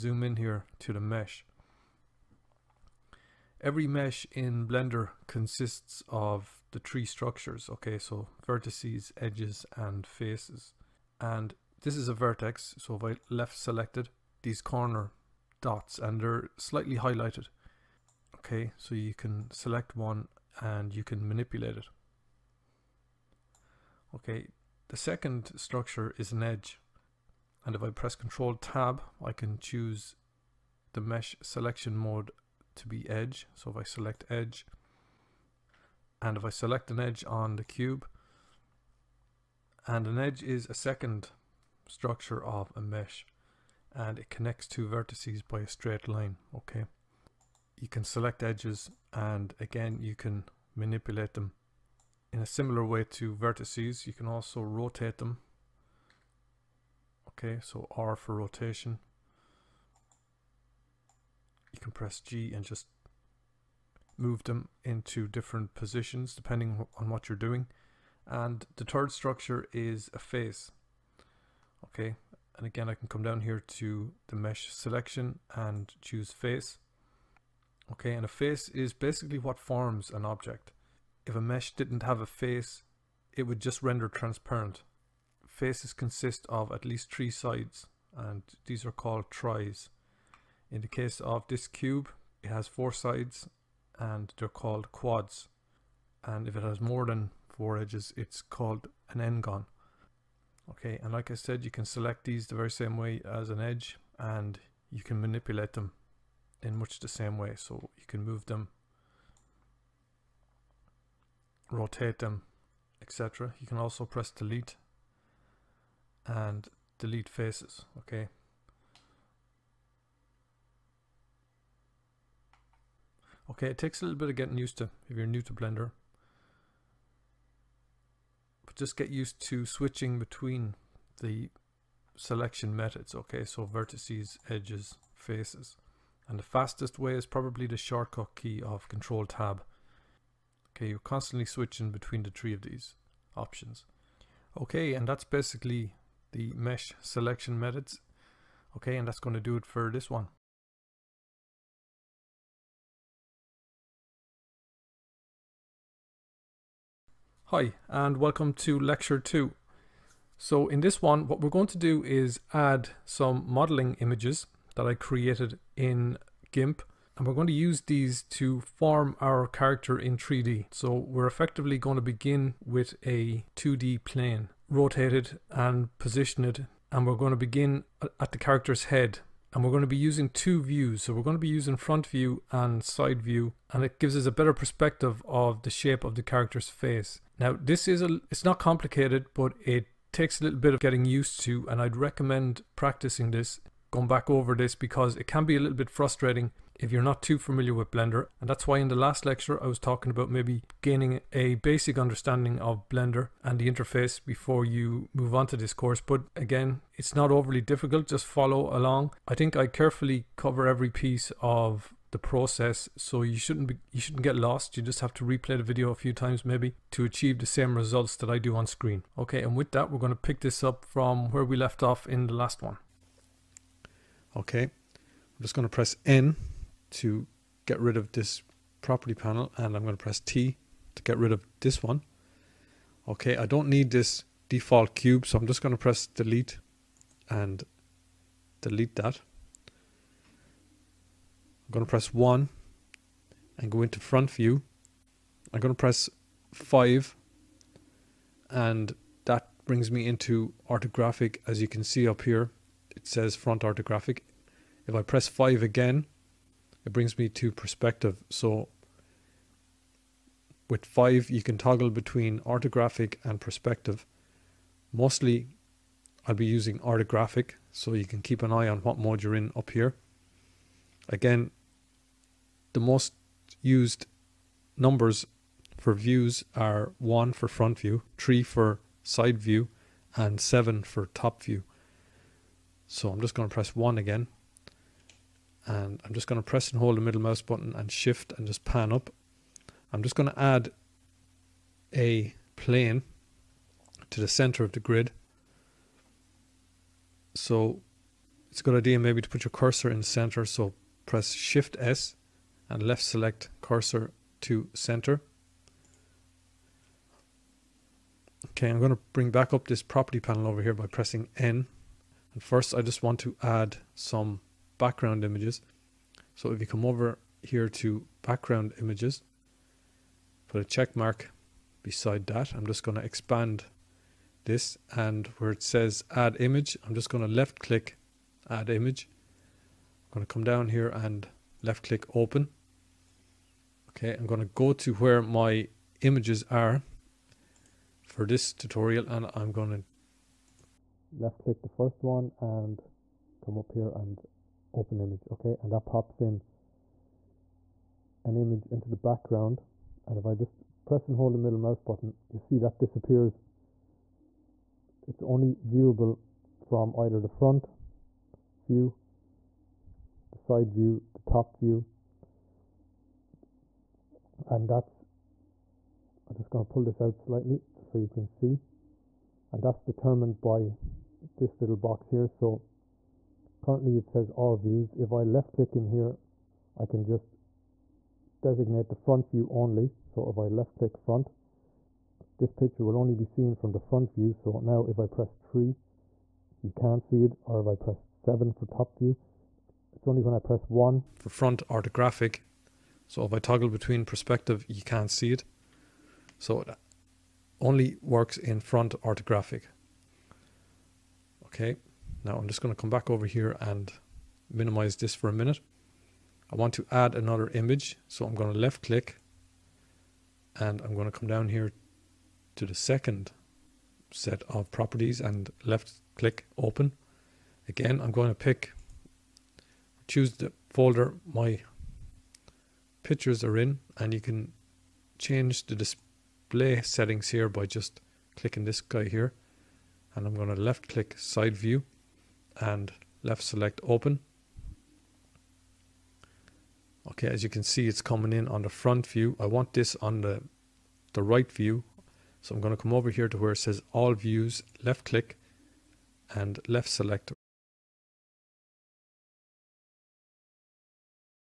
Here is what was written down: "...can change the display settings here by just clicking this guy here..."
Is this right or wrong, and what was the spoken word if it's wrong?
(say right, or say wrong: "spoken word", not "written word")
right.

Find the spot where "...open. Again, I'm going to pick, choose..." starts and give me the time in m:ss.
6:56.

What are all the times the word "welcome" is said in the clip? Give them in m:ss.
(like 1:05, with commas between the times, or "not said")
2:38.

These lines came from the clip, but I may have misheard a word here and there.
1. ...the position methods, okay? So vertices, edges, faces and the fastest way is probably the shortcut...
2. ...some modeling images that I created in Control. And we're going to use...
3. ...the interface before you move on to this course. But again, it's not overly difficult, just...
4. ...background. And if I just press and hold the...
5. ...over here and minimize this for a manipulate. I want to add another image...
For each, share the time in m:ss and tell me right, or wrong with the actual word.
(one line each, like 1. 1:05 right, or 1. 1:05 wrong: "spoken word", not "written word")
1. 2:11 wrong: "selection", not "position"
2. 2:43 wrong: "GIMP", not "Control"
3. 3:23 right
4. 5:48 right
5. 6:43 wrong: "minute", not "manipulate".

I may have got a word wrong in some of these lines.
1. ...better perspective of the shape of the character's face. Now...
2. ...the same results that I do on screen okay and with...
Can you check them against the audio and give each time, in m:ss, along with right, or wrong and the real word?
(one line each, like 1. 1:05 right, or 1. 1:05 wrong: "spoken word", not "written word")
1. 3:04 right
2. 3:37 right.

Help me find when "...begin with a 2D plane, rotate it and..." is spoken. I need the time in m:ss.
2:52.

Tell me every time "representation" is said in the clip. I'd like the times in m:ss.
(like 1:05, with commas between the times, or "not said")
not said.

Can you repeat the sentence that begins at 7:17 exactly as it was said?
Okay, as you can see, it's coming in on the front view.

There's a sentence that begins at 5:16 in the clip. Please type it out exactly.
So if you come over here to background images, put a check mark beside that.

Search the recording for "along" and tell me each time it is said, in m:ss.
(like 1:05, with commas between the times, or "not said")
3:28.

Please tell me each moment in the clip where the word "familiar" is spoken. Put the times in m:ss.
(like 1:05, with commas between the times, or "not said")
3:17.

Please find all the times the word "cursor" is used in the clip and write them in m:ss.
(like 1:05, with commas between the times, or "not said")
4:59, 5:03.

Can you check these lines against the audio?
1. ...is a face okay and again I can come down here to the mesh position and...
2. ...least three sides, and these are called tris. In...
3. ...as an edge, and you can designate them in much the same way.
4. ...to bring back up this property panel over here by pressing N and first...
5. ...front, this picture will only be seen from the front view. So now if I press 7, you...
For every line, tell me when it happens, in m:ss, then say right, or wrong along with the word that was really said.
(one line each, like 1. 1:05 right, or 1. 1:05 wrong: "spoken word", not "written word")
1. 1:09 wrong: "selection", not "position"
2. 1:26 right
3. 1:43 wrong: "manipulate", not "designate"
4. 5:08 right
5. 6:20 wrong: "3", not "7".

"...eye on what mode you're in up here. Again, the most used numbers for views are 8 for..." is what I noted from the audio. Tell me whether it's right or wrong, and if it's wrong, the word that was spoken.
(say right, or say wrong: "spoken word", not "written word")
wrong: "1", not "8".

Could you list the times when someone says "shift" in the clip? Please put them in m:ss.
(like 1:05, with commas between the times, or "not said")
4:47, 5:01.